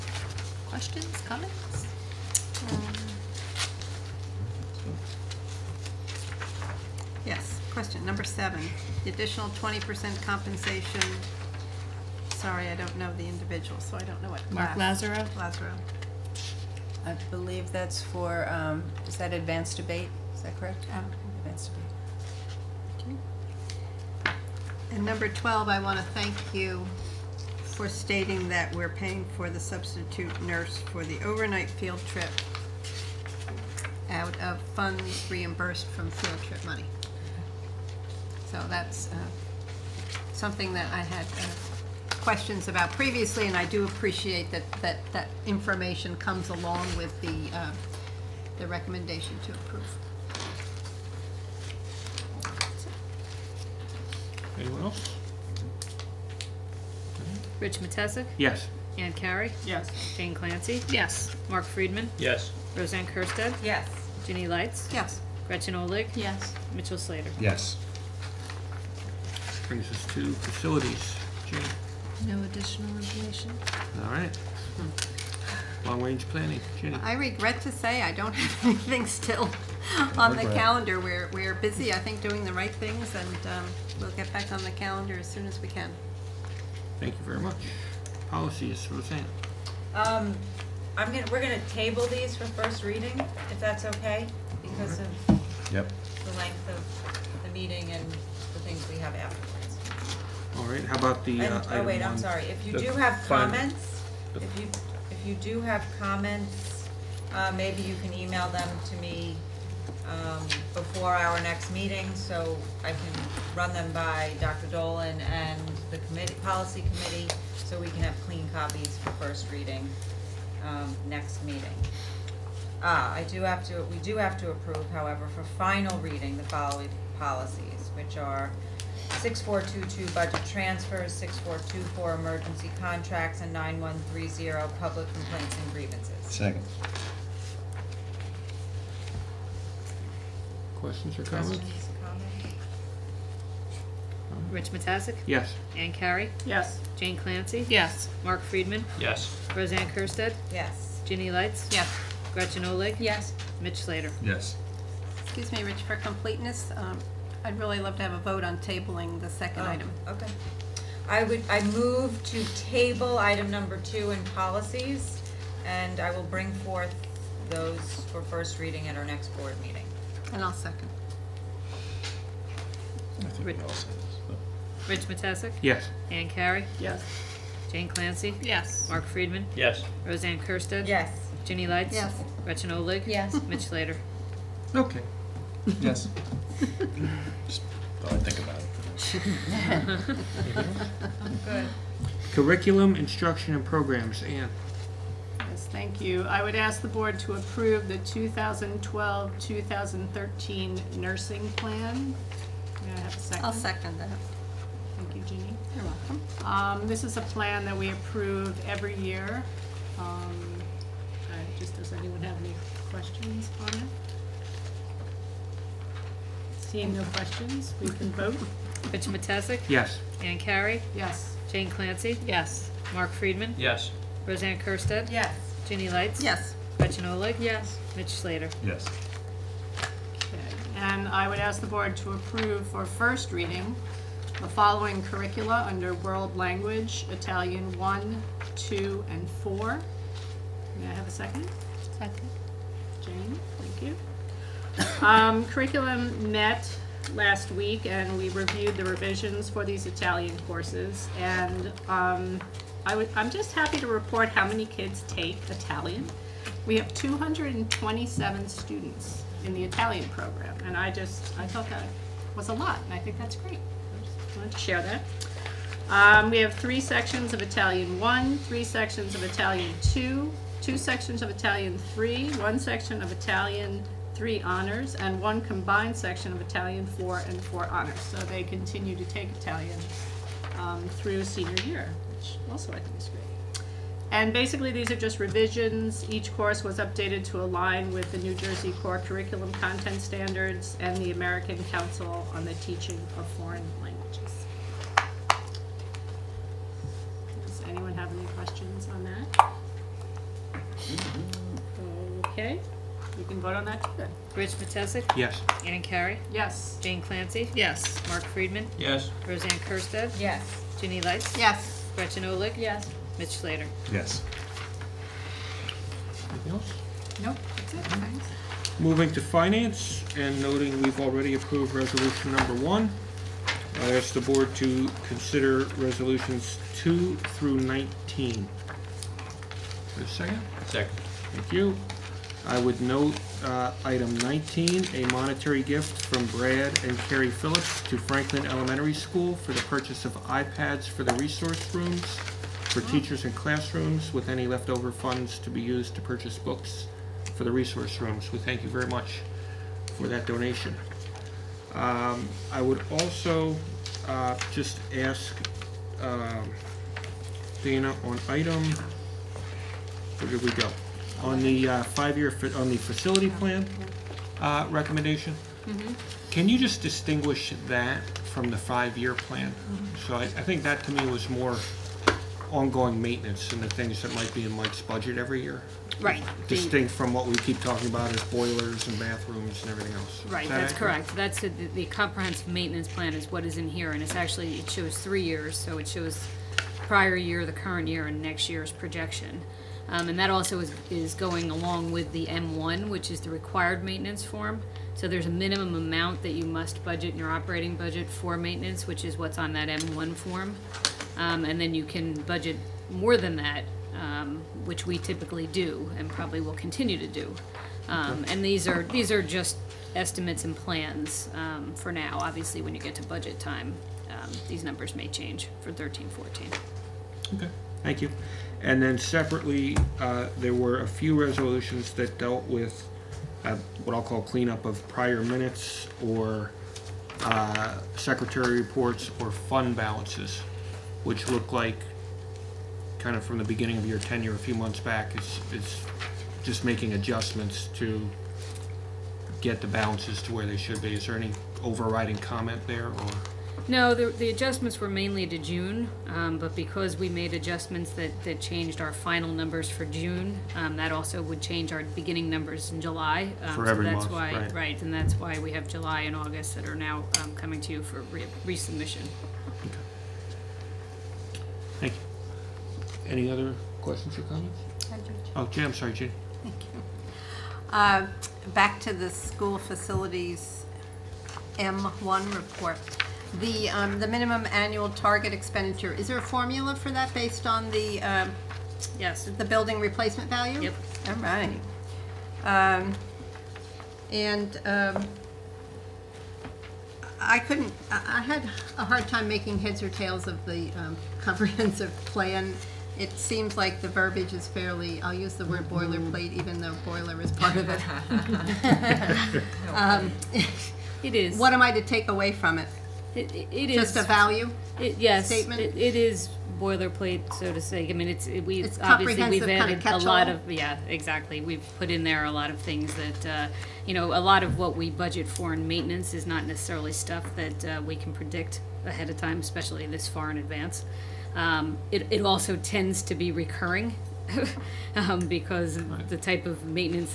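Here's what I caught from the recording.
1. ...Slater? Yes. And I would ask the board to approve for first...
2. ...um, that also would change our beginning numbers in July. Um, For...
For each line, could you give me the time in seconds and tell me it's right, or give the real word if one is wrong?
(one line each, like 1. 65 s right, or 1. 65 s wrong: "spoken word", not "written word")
1. 228 s right
2. 450 s right.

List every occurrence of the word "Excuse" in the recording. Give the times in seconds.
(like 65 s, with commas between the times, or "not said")
155 s.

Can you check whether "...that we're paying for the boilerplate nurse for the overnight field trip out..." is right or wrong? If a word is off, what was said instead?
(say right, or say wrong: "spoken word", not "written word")
wrong: "substitute", not "boilerplate".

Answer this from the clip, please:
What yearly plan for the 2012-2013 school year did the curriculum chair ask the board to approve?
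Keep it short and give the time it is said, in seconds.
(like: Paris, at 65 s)
Nursing plan, at 200 s.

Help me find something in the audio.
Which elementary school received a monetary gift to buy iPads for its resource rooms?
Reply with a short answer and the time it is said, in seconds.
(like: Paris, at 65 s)
Franklin Elementary School, at 337 s.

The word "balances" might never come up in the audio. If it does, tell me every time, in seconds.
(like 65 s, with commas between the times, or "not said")
429 s, 439 s.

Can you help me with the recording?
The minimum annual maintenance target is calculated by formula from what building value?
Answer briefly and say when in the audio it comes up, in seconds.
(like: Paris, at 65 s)
Building replacement value, at 479 s.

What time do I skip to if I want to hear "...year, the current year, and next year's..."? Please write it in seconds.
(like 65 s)
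387 s.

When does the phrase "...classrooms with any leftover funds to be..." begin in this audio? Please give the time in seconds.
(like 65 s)
343 s.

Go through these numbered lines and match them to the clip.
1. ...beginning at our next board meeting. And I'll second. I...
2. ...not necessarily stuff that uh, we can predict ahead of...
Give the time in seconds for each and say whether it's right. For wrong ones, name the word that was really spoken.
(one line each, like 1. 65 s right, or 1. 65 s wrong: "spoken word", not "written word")
1. 168 s wrong: "reading", not "beginning"
2. 516 s right.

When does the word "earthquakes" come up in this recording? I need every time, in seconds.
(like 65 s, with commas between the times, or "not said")
not said.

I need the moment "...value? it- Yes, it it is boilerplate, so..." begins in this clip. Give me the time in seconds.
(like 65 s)
504 s.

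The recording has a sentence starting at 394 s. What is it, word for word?
So there's a minimum amount that you must budget in your operating budget for maintenance, which is what's on that M1 form.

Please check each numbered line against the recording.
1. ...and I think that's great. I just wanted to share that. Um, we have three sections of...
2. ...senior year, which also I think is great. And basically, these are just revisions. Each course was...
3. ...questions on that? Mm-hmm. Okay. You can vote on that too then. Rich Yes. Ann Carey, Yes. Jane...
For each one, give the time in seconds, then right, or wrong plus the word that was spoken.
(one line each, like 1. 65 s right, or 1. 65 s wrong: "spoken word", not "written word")
1. 262 s right
2. 281 s right
3. 298 s right.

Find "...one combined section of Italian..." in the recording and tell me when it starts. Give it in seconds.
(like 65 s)
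275 s.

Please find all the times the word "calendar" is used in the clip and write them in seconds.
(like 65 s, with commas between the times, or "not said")
80 s, 84 s.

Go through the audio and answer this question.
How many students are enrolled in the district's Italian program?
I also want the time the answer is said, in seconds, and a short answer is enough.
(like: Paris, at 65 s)
227, at 256 s.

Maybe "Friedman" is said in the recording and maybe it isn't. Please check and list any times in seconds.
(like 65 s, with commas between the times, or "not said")
61 s, 148 s, 179 s, 223 s, 308 s.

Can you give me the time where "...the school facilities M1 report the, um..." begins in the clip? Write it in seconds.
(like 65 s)
468 s.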